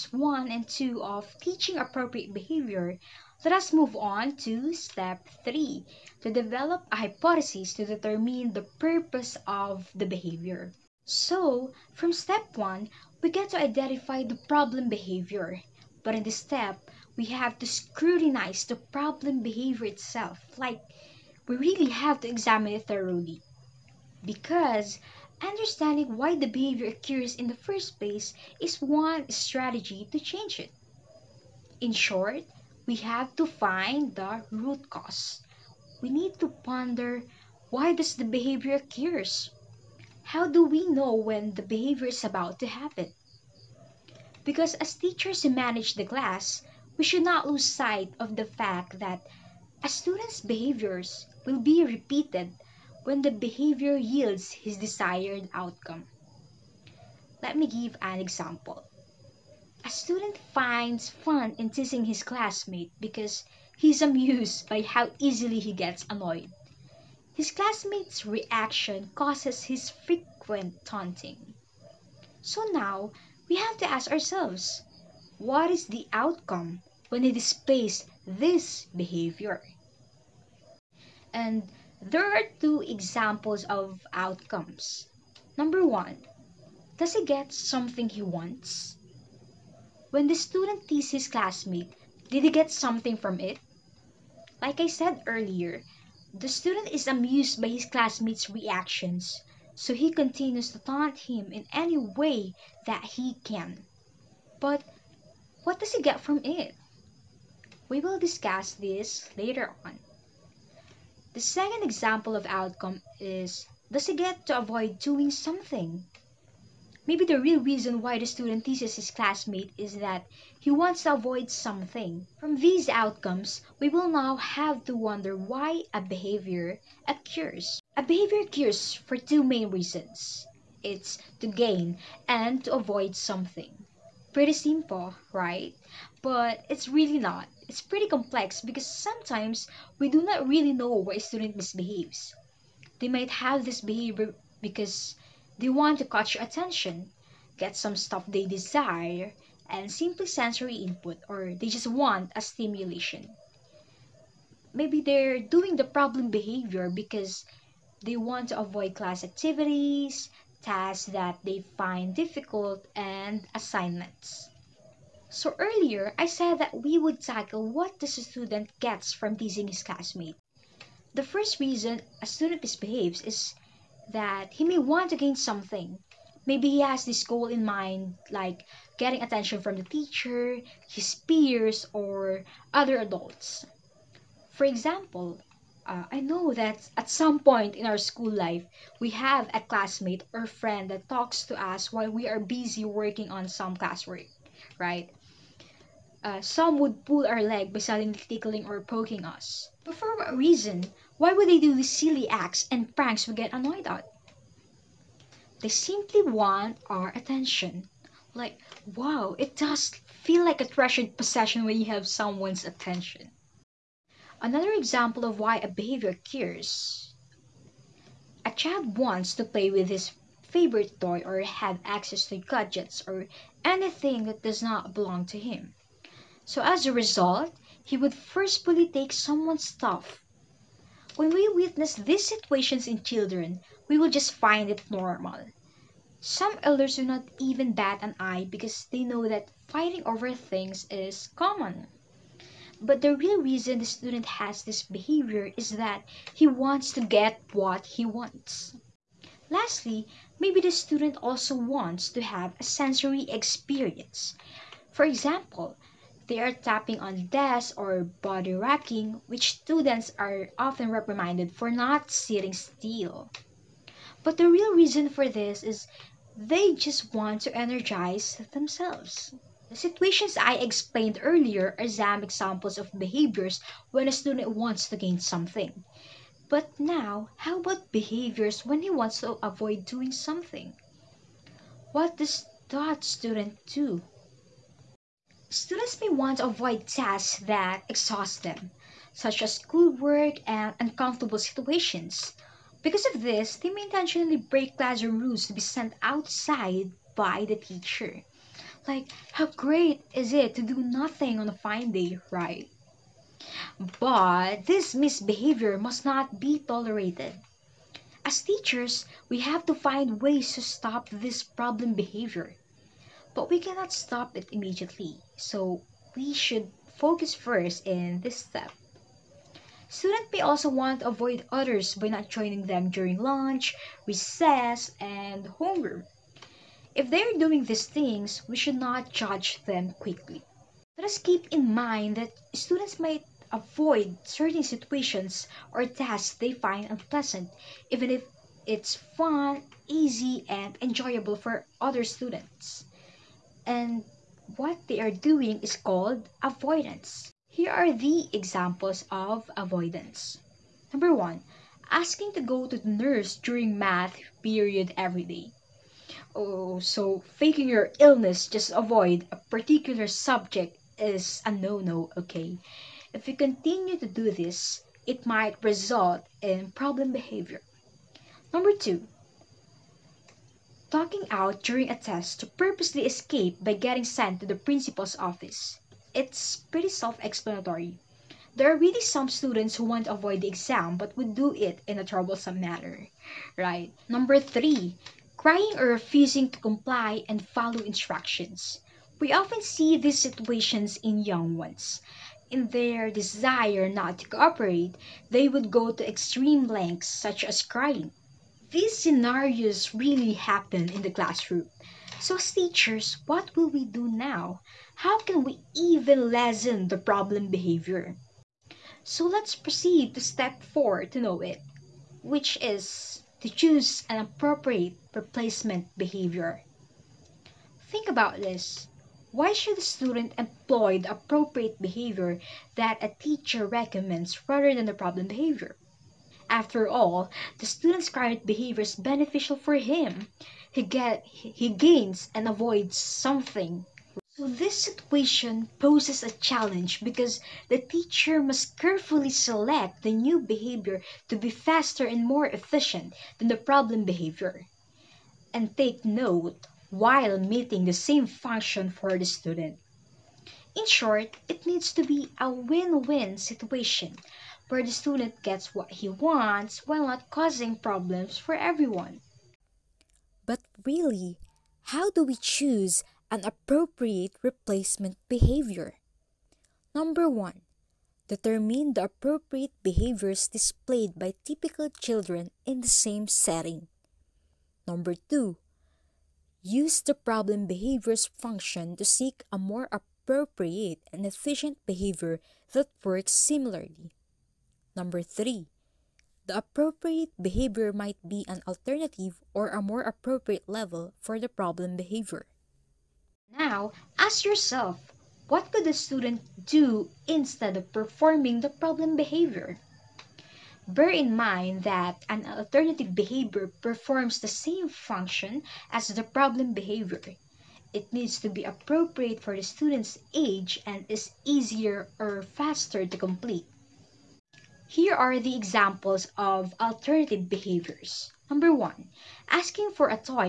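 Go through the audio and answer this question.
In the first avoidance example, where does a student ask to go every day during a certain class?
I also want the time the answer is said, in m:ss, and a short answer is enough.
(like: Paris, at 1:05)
The nurse, at 5:52.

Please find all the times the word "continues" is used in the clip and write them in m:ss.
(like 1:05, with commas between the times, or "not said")
1:40, 6:03.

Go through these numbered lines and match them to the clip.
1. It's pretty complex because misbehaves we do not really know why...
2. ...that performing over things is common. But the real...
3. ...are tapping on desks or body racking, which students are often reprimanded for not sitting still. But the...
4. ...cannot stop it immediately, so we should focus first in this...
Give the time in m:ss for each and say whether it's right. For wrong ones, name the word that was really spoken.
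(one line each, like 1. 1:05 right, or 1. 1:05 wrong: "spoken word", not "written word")
1. 2:17 wrong: "sometimes", not "misbehaves"
2. 3:59 wrong: "fighting", not "performing"
3. 4:16 right
4. 5:13 right.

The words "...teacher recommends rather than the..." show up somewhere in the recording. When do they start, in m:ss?
7:03.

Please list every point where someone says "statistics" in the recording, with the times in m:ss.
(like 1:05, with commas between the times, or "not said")
not said.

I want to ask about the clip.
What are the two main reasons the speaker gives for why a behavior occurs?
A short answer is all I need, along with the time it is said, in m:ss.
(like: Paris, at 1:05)
To gain and to avoid, at 2:11.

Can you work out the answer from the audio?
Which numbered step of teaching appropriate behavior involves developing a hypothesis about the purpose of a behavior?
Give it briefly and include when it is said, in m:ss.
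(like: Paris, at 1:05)
Step 3, at 0:04.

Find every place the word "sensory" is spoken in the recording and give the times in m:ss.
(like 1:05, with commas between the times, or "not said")
2:30, 4:12.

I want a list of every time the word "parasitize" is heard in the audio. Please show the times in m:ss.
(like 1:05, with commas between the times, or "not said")
not said.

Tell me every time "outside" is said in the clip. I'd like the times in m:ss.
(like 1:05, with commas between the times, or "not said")
4:56.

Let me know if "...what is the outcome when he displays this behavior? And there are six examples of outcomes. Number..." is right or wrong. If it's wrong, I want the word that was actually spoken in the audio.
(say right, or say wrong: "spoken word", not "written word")
wrong: "two", not "six".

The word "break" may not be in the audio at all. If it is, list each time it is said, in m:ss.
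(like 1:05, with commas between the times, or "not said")
4:54.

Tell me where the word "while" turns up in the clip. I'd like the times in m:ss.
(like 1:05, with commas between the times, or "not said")
3:11, 7:26, 7:36.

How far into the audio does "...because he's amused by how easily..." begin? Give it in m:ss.
1:02.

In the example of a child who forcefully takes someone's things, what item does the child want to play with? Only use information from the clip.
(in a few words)
His favorite toy.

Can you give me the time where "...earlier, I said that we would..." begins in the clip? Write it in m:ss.
2:45.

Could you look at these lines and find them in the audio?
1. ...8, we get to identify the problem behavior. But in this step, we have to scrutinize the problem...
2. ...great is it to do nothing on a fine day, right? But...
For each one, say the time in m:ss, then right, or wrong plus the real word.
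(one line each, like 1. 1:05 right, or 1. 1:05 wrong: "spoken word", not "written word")
1. 0:12 wrong: "1", not "8"
2. 4:59 right.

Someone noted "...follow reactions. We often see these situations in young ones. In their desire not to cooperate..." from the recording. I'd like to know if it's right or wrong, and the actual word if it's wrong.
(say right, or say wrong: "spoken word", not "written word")
wrong: "instructions", not "reactions".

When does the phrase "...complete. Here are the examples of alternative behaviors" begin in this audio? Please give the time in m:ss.
8:33.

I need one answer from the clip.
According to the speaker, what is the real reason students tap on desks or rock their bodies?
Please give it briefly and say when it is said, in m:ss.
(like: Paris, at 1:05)
To energize themselves, at 4:27.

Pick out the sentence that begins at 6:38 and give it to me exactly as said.
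These scenarios really happen in the classroom.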